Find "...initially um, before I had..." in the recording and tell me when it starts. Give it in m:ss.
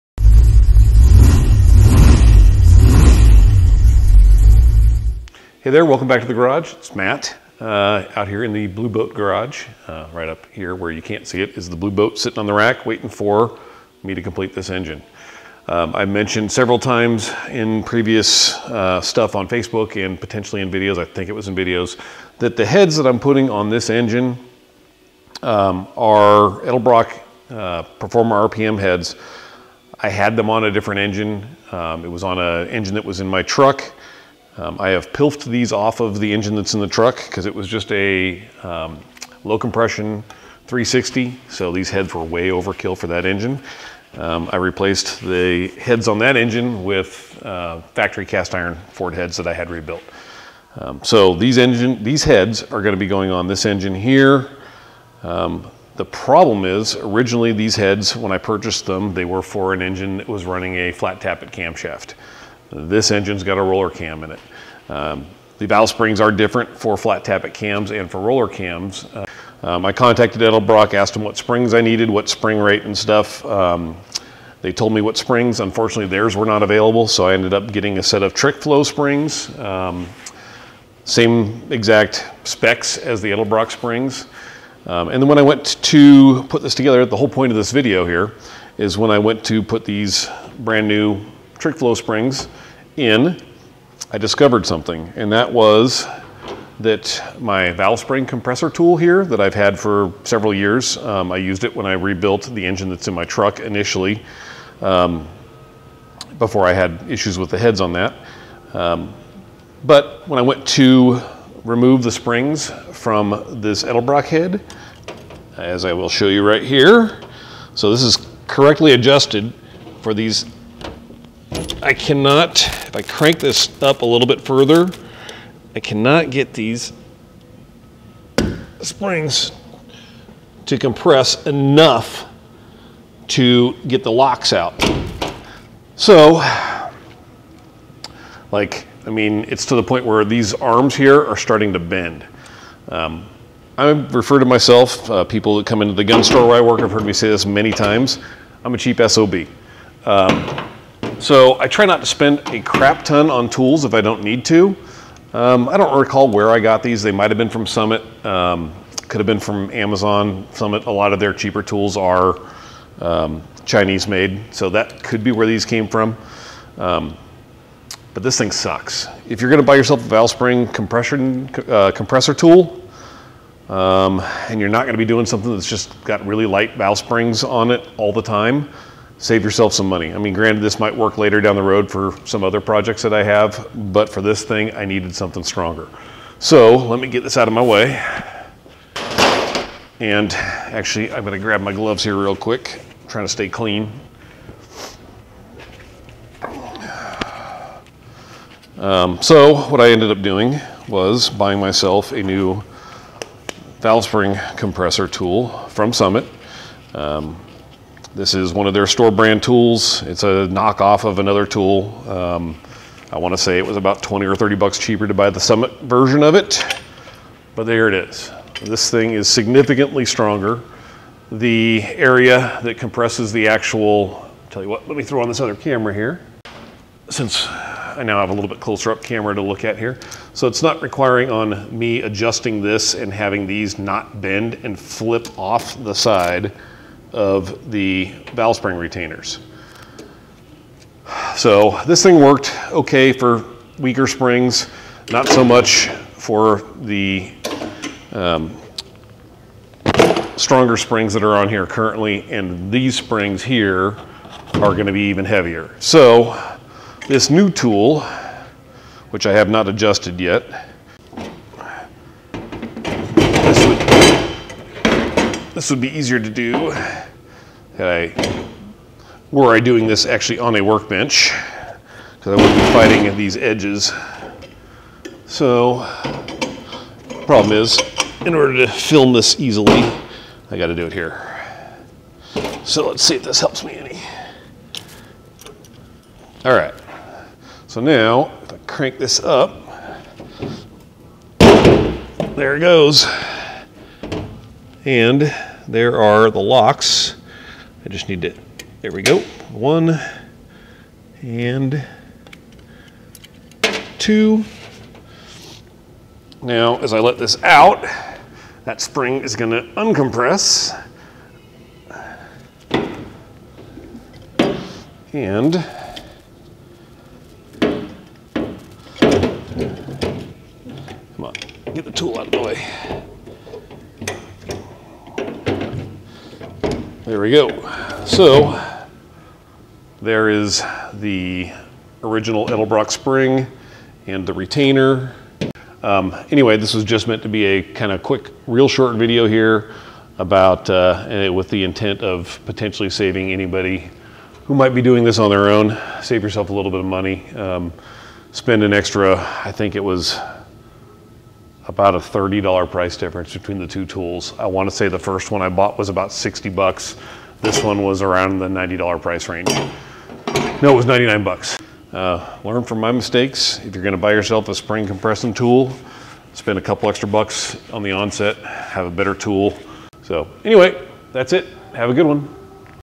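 1:43.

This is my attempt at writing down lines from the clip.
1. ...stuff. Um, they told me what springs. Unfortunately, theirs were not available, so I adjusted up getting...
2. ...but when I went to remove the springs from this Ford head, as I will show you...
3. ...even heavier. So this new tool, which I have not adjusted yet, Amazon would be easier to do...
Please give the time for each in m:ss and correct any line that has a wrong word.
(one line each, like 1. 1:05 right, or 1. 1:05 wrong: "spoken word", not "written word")
1. 1:12 wrong: "ended", not "adjusted"
2. 1:49 wrong: "Edelbrock", not "Ford"
3. 4:15 wrong: "This", not "Amazon".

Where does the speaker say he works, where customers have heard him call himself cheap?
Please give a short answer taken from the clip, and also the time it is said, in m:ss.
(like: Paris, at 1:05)
gun store, at 2:26.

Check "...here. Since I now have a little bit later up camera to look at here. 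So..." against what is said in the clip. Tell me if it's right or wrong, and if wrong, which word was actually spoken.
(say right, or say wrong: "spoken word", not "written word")
wrong: "closer", not "later".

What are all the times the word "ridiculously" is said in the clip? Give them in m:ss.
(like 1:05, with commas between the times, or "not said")
not said.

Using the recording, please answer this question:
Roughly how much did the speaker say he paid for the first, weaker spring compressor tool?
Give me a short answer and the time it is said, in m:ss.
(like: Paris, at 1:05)
$60, at 5:56.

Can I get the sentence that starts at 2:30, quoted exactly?
Um, so I try not to spend a crap ton on tools if I don't need to.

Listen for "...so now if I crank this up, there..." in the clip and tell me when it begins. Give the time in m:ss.
4:47.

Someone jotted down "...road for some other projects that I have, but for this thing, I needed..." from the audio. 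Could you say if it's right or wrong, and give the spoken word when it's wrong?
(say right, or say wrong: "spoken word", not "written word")
right.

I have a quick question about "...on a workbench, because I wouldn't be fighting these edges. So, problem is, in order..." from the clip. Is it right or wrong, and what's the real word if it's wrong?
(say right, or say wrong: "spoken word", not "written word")
right.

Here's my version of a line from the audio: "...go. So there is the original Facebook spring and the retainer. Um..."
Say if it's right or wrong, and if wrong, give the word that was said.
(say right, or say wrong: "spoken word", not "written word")
wrong: "Edelbrock", not "Facebook".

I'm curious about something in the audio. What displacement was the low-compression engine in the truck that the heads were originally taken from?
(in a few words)
360.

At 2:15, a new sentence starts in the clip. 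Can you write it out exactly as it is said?
So, like, I mean, it's to the point where these arms here are starting to bend.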